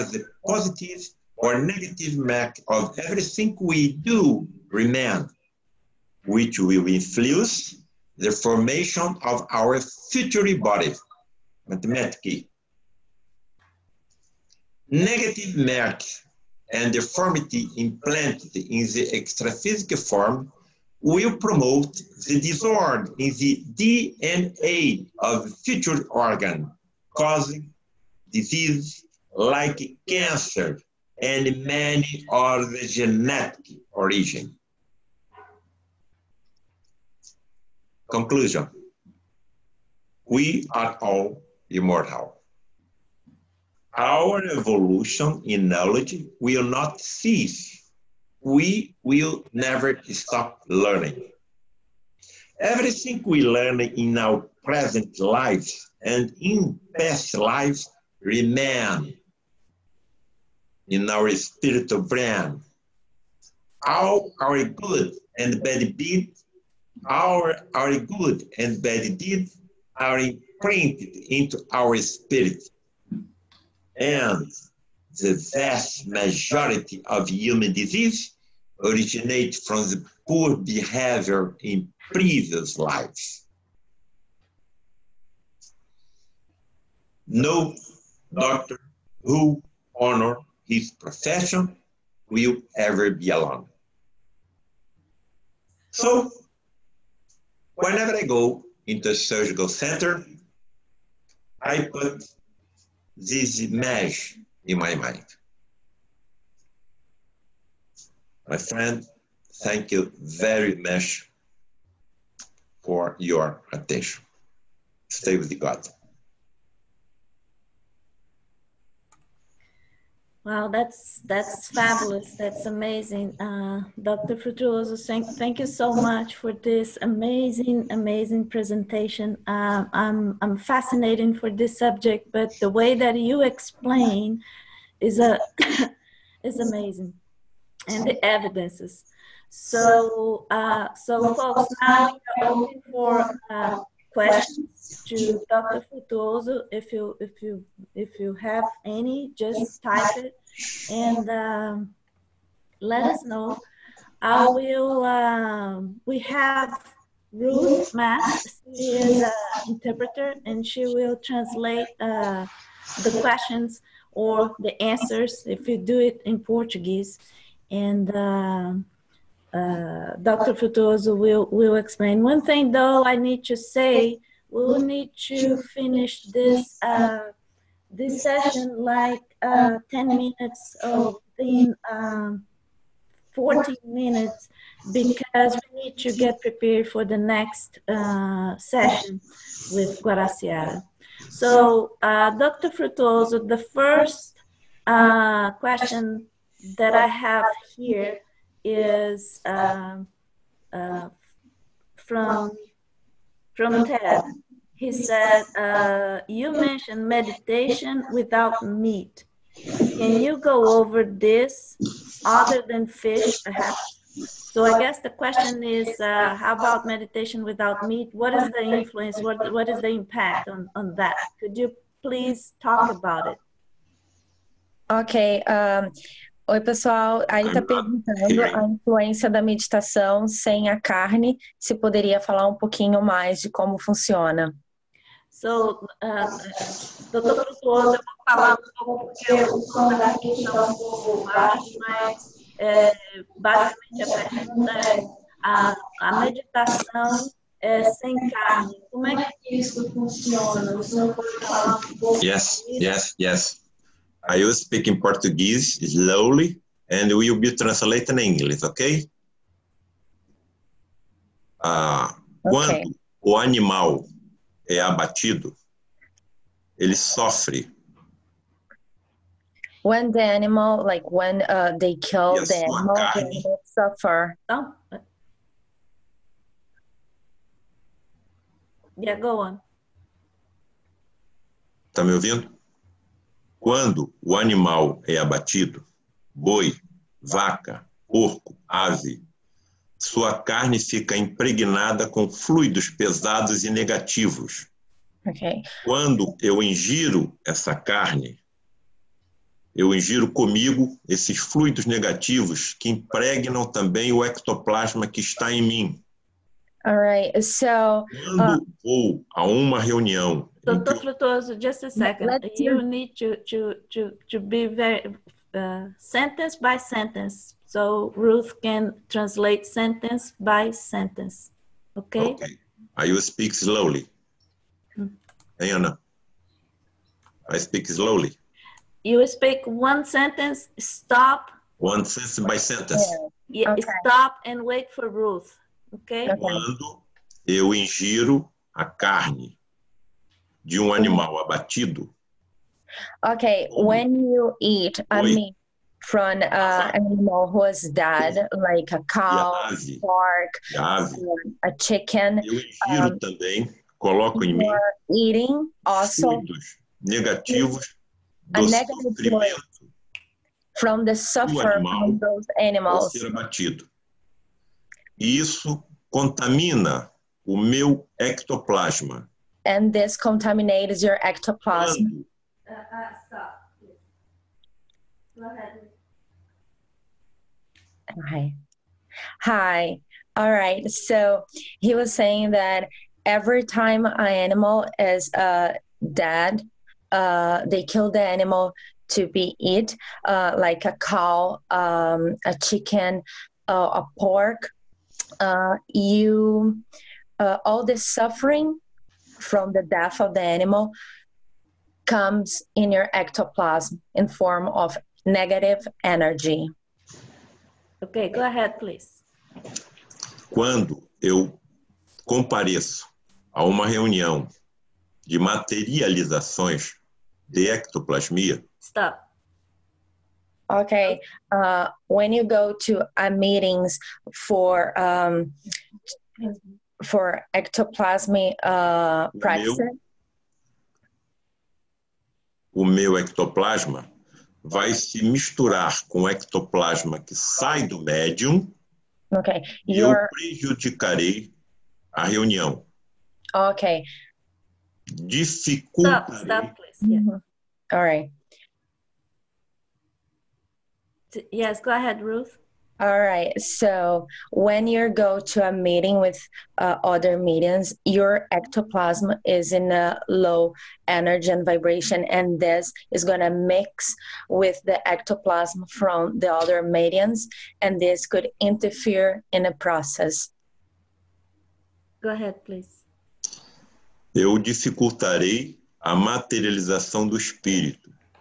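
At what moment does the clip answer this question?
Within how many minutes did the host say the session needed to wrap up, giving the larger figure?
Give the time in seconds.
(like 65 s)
183 s.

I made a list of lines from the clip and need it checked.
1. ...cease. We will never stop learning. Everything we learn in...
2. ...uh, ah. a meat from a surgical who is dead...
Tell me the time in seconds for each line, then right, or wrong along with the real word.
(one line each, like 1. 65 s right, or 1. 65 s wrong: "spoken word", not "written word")
1. 46 s right
2. 344 s wrong: "animal", not "surgical".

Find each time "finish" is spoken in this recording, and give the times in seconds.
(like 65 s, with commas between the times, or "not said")
175 s.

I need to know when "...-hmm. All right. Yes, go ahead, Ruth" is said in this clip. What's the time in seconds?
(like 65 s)
447 s.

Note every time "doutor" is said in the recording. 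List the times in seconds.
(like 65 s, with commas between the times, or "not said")
237 s, 310 s.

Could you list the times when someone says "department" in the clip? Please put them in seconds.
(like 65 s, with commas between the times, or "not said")
not said.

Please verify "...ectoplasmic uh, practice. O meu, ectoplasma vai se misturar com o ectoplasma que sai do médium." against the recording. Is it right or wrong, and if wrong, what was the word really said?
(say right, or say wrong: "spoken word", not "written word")
right.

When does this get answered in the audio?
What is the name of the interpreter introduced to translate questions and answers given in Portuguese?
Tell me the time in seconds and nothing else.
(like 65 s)
157 s.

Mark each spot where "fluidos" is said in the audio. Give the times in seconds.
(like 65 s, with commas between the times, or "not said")
292 s, 301 s.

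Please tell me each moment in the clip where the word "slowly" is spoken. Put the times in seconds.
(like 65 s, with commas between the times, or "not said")
255 s, 323 s, 327 s.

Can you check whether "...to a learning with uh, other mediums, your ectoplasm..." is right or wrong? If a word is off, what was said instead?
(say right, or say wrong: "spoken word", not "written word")
wrong: "meeting", not "learning".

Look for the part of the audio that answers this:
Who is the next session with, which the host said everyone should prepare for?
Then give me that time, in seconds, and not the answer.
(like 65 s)
190 s.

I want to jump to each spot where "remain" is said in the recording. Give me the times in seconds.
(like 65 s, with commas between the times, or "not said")
4 s, 58 s.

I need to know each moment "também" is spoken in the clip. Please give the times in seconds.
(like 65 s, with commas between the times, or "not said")
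303 s, 353 s.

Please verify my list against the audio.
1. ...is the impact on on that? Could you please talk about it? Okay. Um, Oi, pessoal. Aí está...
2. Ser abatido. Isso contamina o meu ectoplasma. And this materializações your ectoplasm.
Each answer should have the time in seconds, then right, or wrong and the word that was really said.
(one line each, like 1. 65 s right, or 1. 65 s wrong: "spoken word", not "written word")
1. 219 s right
2. 363 s wrong: "contaminates", not "materializações".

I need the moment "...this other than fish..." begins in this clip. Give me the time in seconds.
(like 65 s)
211 s.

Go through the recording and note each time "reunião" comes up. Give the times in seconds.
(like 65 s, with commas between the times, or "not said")
309 s, 413 s, 442 s.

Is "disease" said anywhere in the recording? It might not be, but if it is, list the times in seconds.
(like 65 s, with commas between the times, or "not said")
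28 s, 77 s.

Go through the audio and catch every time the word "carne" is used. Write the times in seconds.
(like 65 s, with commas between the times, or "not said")
230 s, 248 s, 272 s, 290 s, 297 s, 338 s.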